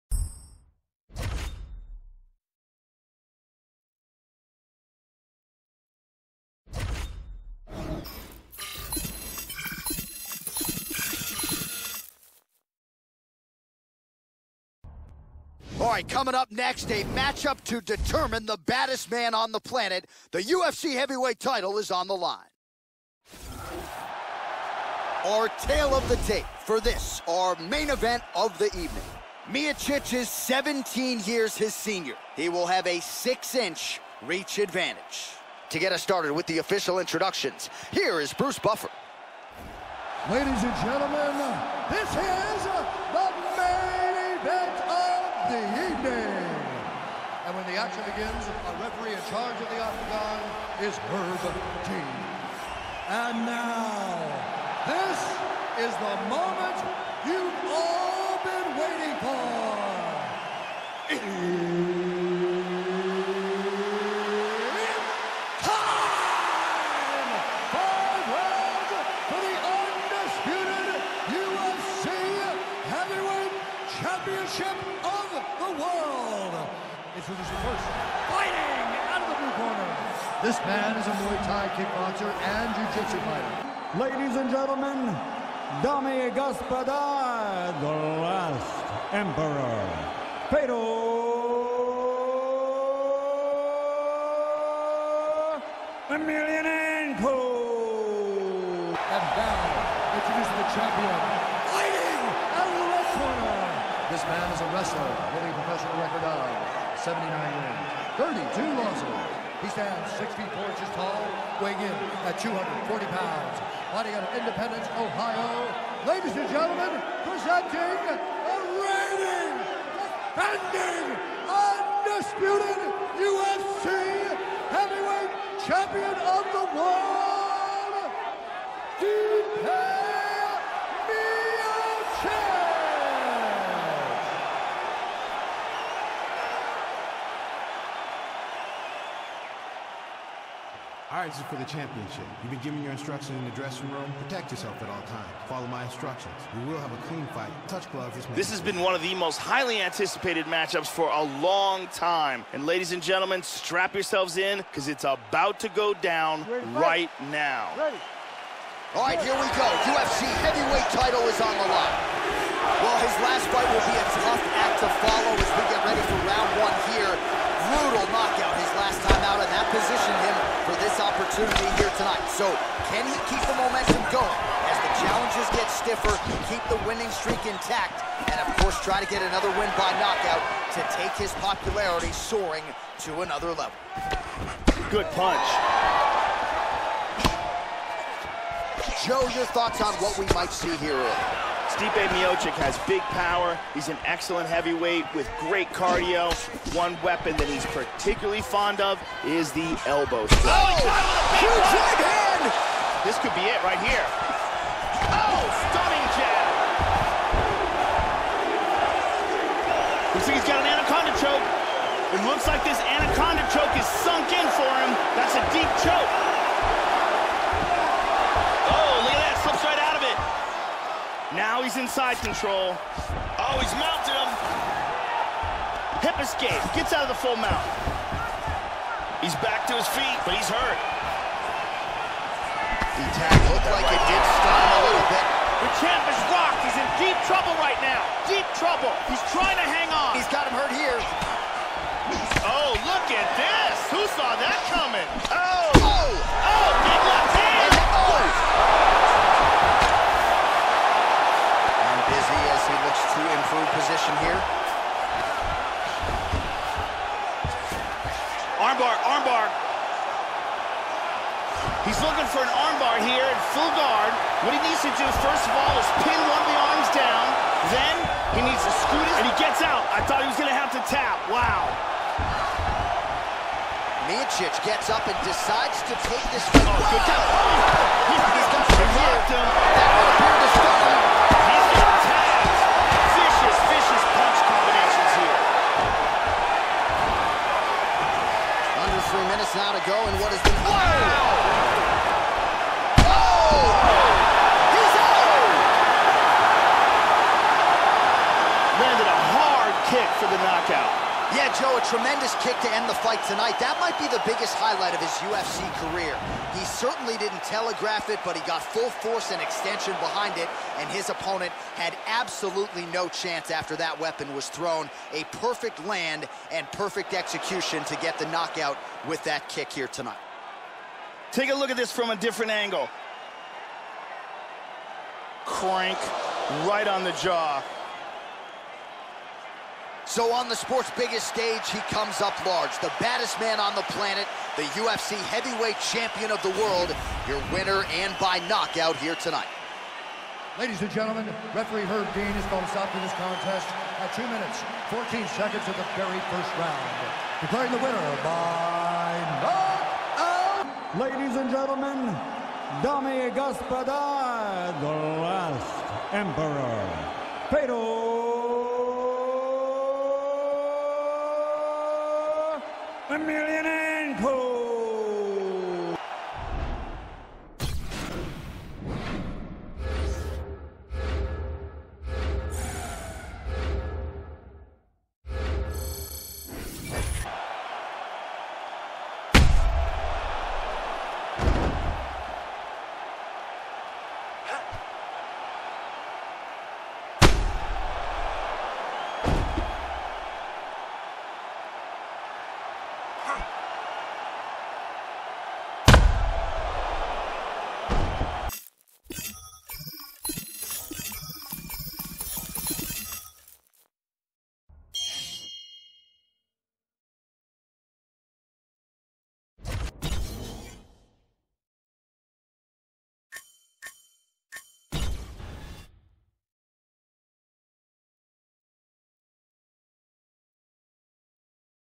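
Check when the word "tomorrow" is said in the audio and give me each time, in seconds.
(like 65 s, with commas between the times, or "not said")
not said.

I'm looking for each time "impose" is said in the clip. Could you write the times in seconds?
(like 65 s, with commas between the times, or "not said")
not said.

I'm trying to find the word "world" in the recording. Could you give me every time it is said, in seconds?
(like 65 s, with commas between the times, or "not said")
126 s, 336 s.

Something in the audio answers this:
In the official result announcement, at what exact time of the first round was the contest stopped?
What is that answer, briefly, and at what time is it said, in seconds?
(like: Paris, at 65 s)
2 minutes, 14 seconds, at 344 s.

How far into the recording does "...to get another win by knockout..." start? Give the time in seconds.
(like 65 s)
179 s.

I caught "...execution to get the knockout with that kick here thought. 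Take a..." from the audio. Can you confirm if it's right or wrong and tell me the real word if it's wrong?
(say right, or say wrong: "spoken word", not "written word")
wrong: "tonight", not "thought".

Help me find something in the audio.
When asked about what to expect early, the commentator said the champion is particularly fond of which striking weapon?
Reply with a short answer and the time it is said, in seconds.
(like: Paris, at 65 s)
Elbow strike, at 199 s.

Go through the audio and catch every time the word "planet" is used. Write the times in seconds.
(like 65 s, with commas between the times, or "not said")
19 s, 333 s.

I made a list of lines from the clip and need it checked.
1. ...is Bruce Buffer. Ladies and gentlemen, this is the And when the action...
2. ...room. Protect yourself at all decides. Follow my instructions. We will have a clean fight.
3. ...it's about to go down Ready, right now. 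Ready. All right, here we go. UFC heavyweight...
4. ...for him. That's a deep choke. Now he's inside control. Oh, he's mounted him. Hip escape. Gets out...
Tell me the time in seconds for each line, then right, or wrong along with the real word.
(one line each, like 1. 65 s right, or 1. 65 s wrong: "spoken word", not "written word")
1. 38 s right
2. 143 s wrong: "times", not "decides"
3. 154 s right
4. 214 s right.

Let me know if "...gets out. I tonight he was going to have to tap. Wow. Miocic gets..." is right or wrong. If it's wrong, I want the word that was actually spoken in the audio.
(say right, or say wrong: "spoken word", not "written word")
wrong: "thought", not "tonight".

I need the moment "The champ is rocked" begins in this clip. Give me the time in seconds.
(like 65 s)
235 s.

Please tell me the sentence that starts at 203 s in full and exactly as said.
This could be it right here.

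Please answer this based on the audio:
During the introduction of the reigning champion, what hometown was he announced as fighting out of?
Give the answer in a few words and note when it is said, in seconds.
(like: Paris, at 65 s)
Independence, Ohio, at 114 s.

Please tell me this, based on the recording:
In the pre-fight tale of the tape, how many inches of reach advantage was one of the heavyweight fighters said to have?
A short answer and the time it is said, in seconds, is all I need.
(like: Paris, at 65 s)
6, at 33 s.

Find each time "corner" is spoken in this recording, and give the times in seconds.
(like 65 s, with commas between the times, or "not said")
79 s, 103 s.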